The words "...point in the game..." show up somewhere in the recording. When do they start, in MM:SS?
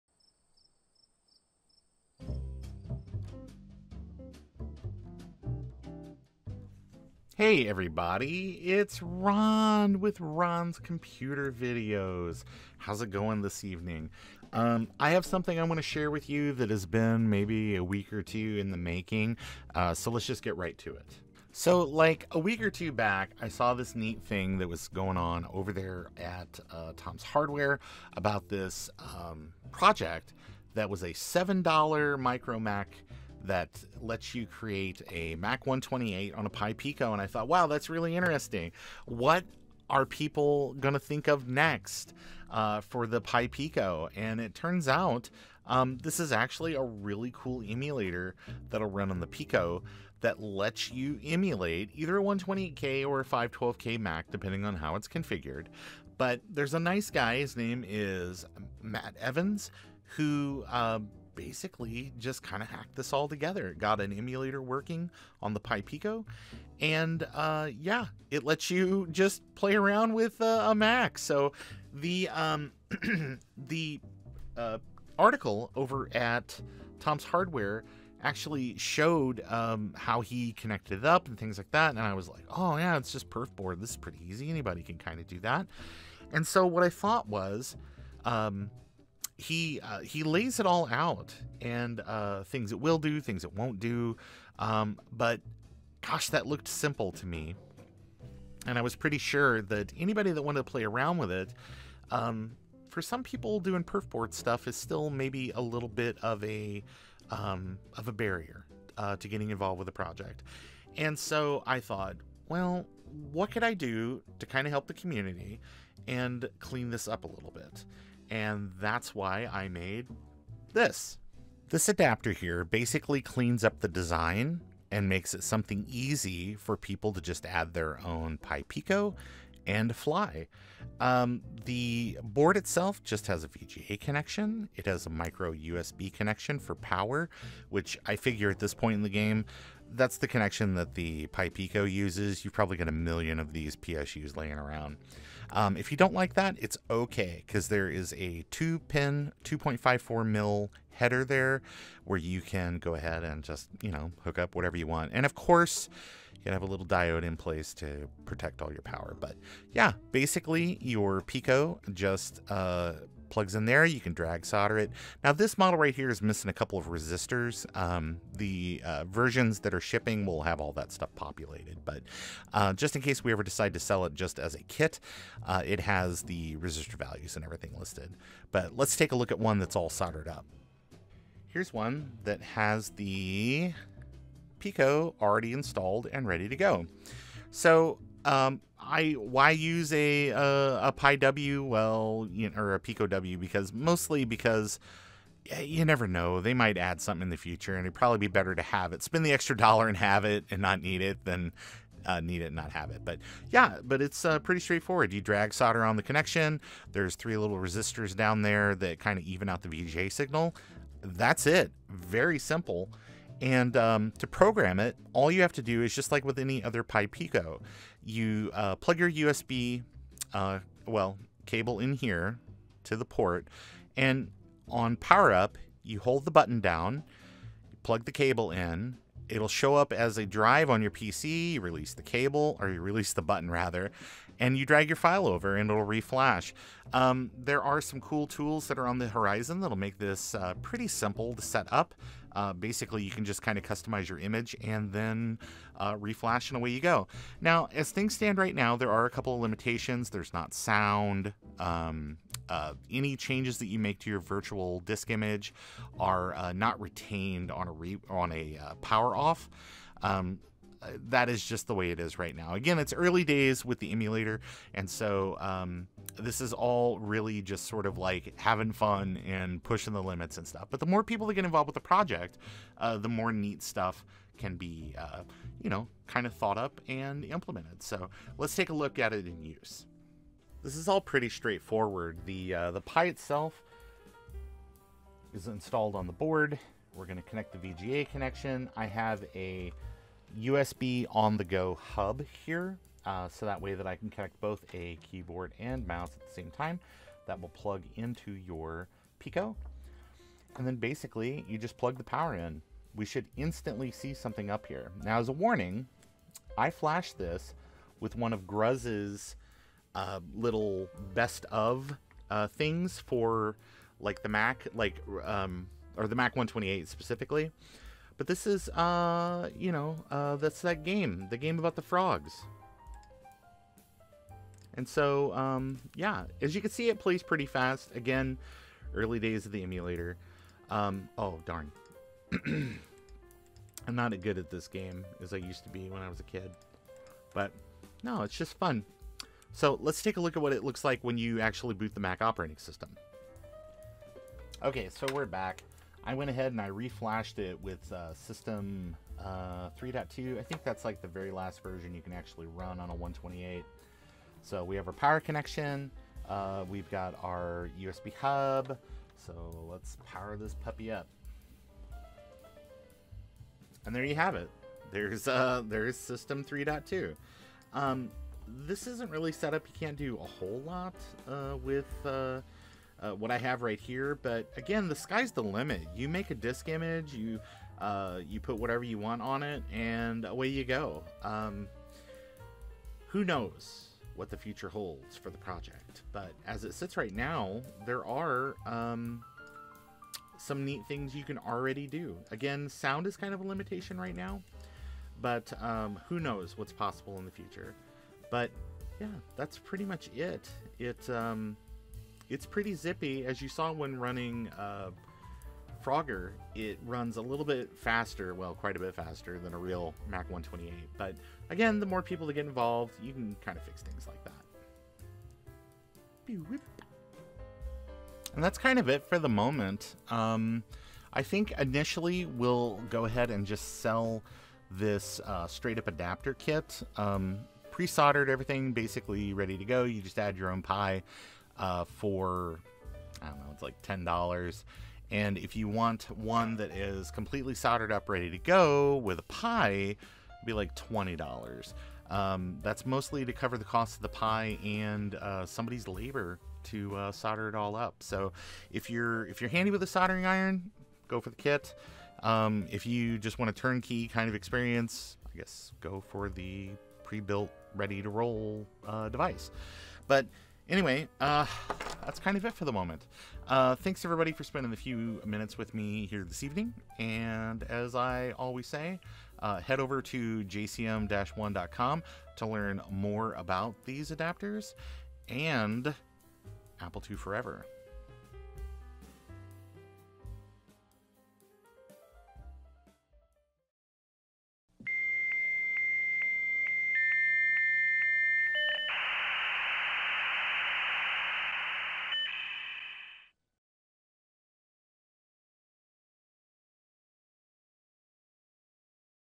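02:18.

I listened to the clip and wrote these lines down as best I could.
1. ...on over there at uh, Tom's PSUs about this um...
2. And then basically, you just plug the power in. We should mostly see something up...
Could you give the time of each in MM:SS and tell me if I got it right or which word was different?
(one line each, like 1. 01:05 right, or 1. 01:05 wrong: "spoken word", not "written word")
1. 00:25 wrong: "Hardware", not "PSUs"
2. 05:00 wrong: "instantly", not "mostly".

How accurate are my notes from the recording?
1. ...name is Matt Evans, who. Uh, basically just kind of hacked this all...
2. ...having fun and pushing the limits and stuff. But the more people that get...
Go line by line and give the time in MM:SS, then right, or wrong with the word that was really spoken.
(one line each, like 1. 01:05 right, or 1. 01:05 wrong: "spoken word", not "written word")
1. 00:57 right
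2. 04:28 right.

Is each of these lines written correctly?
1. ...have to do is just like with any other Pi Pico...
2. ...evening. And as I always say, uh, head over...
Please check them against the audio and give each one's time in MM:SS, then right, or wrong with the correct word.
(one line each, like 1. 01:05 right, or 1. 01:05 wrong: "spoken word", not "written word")
1. 03:35 right
2. 07:46 right.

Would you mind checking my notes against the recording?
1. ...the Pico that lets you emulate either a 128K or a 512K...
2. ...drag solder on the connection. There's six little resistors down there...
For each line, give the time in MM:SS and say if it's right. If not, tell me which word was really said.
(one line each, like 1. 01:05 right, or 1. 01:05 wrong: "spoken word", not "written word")
1. 00:49 right
2. 03:25 wrong: "three", not "six".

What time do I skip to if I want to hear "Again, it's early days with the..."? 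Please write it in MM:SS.
04:22.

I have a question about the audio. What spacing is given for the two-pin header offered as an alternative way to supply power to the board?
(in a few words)
2.54 mil.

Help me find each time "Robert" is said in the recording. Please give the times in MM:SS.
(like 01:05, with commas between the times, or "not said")
not said.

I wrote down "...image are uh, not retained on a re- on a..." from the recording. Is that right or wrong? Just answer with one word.
right.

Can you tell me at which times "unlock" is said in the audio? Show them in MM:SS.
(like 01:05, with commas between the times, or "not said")
not said.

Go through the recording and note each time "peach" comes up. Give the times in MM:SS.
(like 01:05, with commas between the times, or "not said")
not said.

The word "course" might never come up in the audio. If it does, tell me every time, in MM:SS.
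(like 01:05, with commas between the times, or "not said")
02:35.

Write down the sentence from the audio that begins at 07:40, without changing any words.
But Anyway, uh, that's kind of it for the moment.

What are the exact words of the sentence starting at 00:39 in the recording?
What are people going to think of next uh, for the Pi Pico?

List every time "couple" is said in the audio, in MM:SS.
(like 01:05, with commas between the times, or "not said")
02:46, 04:09.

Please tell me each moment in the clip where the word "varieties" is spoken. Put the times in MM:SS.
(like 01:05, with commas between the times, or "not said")
not said.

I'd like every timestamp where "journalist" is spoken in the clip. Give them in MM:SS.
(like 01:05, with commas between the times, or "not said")
not said.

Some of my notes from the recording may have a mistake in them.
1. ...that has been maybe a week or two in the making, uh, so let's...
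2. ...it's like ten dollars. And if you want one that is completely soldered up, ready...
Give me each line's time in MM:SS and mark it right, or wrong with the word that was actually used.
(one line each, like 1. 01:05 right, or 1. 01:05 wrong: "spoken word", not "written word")
1. 00:16 right
2. 07:13 right.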